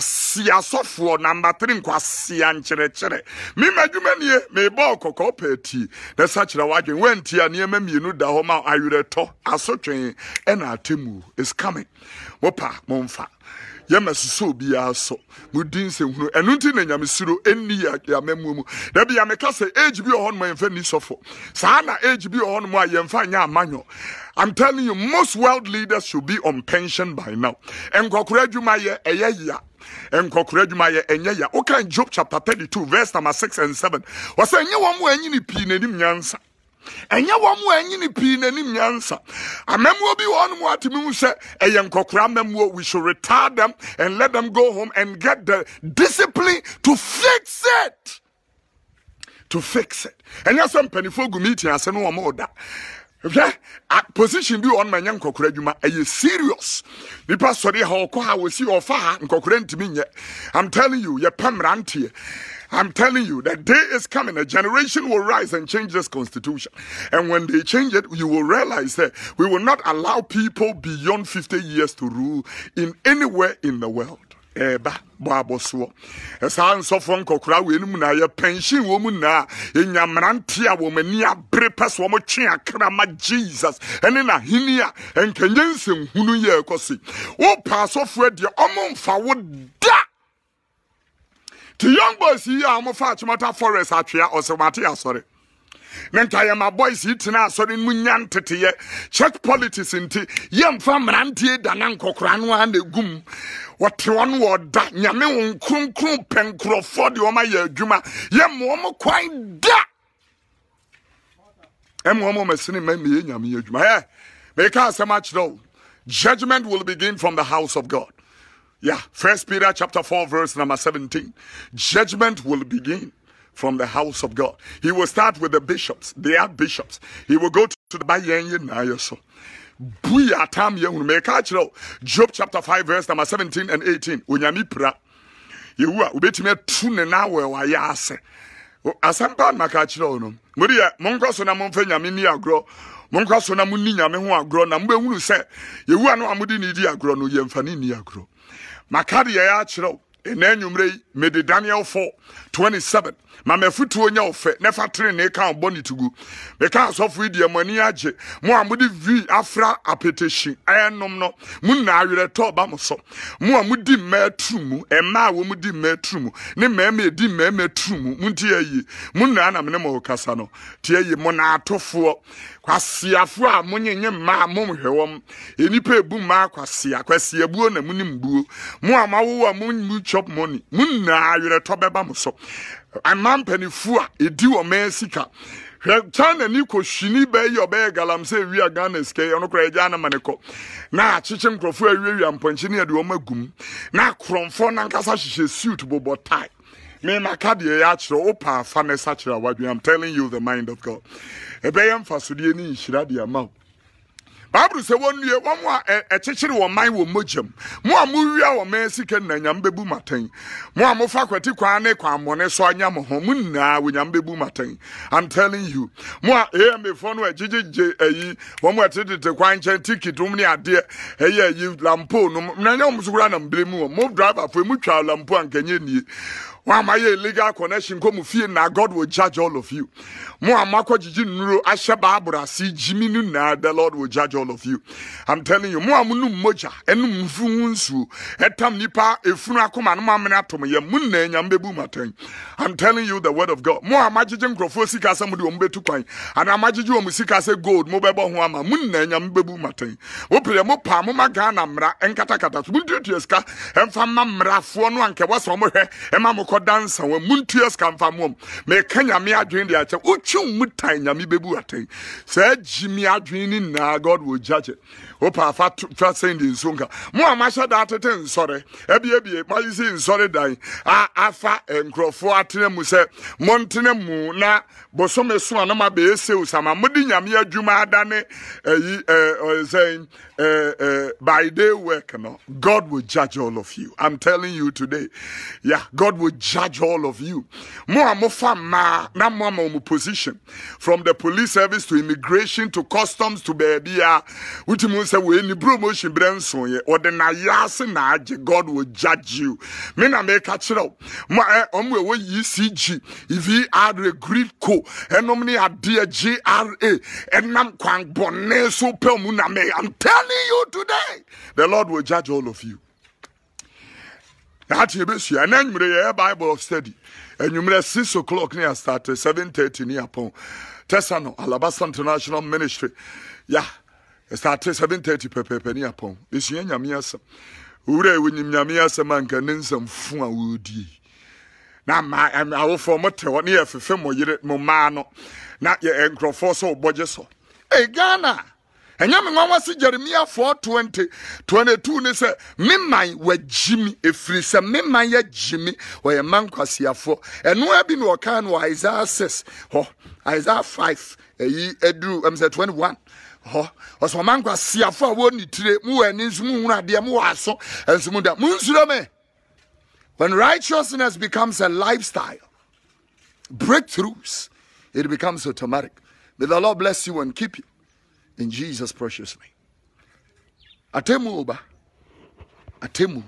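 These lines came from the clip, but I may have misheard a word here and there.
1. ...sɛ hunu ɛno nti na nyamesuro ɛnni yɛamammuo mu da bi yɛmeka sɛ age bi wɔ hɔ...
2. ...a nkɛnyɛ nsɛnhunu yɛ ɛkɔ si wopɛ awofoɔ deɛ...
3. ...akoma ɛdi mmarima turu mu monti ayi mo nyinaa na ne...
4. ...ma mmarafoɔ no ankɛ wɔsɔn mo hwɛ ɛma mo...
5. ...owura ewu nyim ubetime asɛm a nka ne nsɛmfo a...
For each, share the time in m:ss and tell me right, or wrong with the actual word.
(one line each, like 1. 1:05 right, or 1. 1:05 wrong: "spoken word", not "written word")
1. 0:15 right
2. 1:24 wrong: "asɔfoɔ", not "awofoɔ"
3. 2:46 wrong: "mmarima", not "akoma"
4. 4:14 right
5. 5:27 wrong: "nyame", not "ubetime".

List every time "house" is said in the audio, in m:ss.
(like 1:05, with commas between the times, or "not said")
1:57, 2:03.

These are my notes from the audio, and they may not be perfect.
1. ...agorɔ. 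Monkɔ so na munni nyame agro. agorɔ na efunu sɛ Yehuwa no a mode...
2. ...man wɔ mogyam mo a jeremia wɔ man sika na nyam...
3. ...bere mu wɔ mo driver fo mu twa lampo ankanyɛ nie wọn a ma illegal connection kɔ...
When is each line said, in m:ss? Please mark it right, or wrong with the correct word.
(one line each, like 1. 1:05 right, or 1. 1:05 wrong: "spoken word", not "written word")
1. 2:22 wrong: "mubehunu", not "efunu"
2. 3:26 wrong: "mowia", not "jeremia"
3. 3:43 right.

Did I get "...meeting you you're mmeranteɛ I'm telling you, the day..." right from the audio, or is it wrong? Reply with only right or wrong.
wrong.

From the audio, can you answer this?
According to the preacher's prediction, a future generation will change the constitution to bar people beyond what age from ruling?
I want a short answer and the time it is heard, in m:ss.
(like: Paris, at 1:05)
50, at 1:11.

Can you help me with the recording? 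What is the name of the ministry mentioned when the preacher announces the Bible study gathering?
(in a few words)
Alabasa International Ministry.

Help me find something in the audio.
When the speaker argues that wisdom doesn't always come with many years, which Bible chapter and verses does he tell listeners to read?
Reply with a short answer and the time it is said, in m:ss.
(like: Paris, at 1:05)
Job 32:6-7, at 0:31.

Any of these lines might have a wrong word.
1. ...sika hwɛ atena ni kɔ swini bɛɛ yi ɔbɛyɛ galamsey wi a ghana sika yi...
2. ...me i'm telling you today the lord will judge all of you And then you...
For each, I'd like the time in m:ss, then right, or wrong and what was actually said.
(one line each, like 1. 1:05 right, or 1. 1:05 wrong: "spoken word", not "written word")
1. 3:04 wrong: "china", not "atena"
2. 5:09 right.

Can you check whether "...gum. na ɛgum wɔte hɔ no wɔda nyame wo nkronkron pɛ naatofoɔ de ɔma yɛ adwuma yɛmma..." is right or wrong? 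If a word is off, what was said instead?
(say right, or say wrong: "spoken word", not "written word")
wrong: "nkurɔfoɔ", not "naatofoɔ".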